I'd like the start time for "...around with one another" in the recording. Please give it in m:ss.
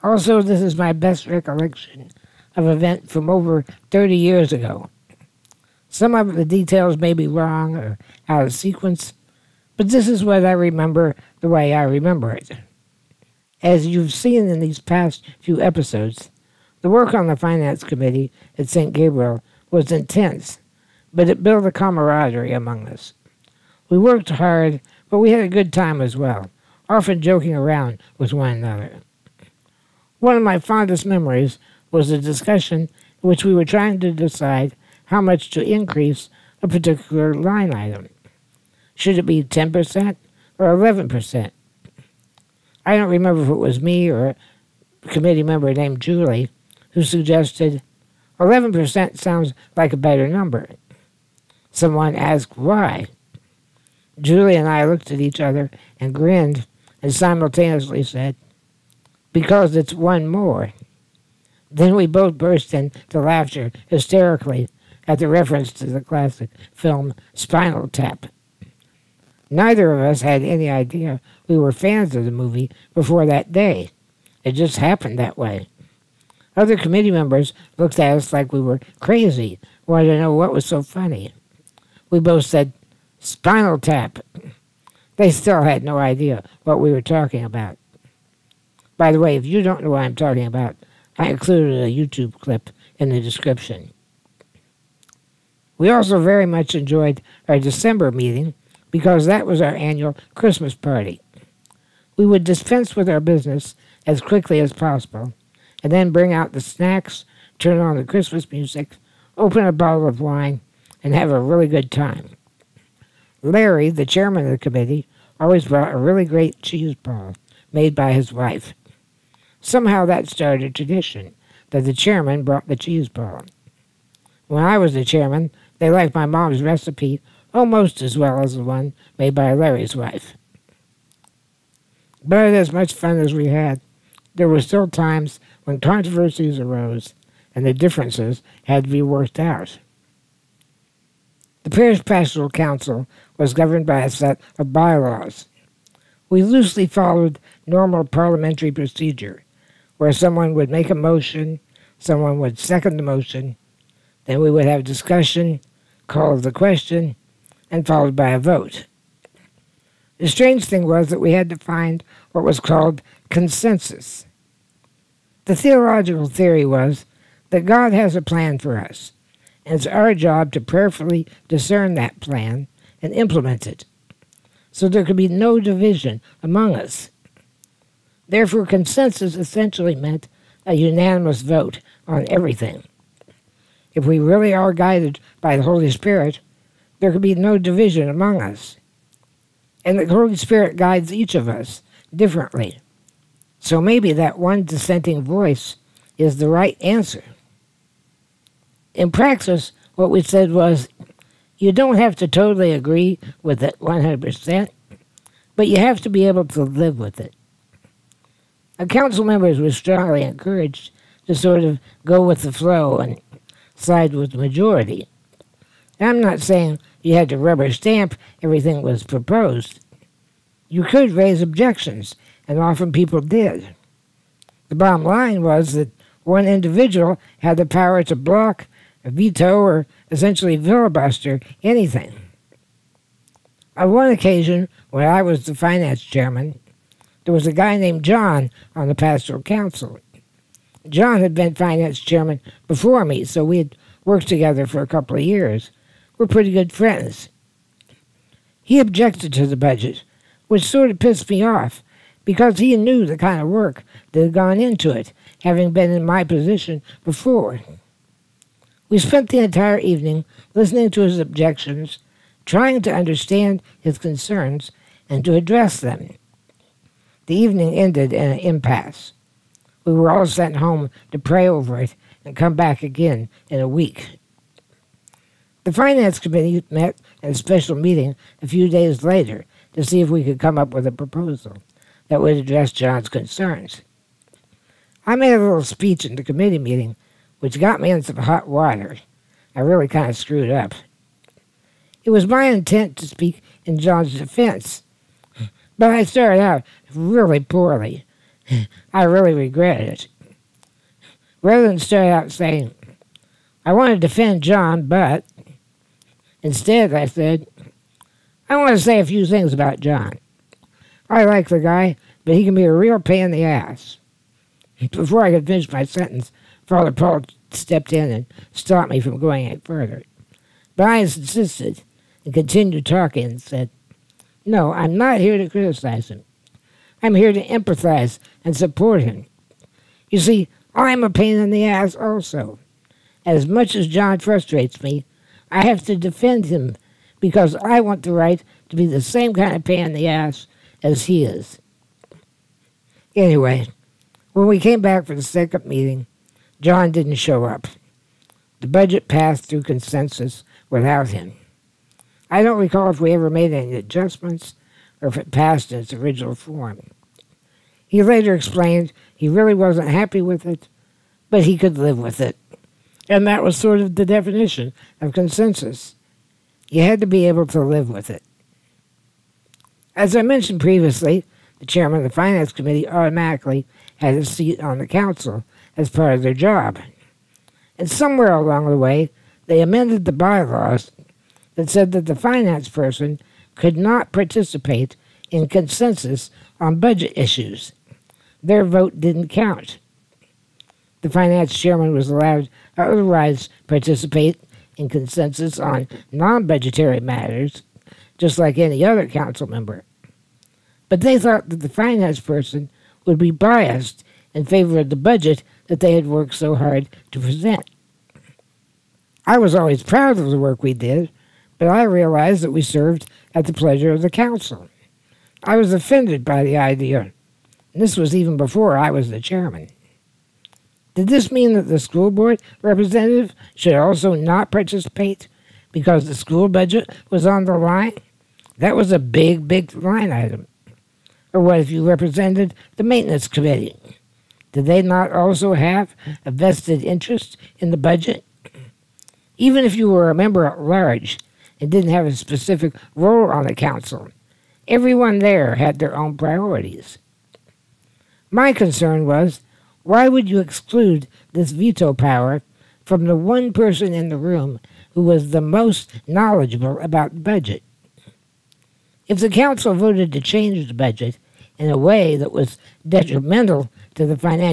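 0:27.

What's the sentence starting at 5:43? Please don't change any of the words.
Anyway, when we came back for the second meeting, John didn't show up.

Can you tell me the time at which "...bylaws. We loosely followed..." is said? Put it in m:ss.
2:24.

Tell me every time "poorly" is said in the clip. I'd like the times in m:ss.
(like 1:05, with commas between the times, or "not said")
4:57.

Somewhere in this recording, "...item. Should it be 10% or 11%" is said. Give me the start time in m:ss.
0:37.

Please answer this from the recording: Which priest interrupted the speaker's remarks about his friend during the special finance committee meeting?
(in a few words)
Father Paul.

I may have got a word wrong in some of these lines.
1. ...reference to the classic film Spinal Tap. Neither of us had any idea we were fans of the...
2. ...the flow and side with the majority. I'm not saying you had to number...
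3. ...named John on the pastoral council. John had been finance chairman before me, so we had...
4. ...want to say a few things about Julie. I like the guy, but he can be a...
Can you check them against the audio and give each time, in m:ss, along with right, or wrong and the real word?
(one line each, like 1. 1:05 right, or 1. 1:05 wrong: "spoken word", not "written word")
1. 1:05 right
2. 3:32 wrong: "rubber", not "number"
3. 3:57 right
4. 5:08 wrong: "John", not "Julie".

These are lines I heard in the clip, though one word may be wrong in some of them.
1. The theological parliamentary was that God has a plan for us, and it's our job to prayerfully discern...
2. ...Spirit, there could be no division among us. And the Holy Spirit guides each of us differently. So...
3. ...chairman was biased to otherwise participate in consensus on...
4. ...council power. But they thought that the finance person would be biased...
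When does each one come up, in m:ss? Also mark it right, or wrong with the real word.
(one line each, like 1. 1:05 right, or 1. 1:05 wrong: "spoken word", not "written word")
1. 2:45 wrong: "theory", not "parliamentary"
2. 3:05 right
3. 6:31 wrong: "allowed", not "biased"
4. 6:39 wrong: "member", not "power".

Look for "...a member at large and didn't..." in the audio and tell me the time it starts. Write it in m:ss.
7:20.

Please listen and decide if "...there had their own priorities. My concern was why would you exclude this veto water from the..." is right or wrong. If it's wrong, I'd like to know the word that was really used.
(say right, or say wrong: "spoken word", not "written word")
wrong: "power", not "water".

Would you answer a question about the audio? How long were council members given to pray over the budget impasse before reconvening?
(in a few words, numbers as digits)
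a week.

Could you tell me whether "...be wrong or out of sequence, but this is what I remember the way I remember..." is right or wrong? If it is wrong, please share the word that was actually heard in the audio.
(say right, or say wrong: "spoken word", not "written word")
right.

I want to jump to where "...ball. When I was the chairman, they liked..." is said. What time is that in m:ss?
2:03.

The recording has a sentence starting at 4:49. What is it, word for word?
I really kind of screwed up.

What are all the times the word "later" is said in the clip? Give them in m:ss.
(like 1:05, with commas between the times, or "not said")
4:39, 5:58.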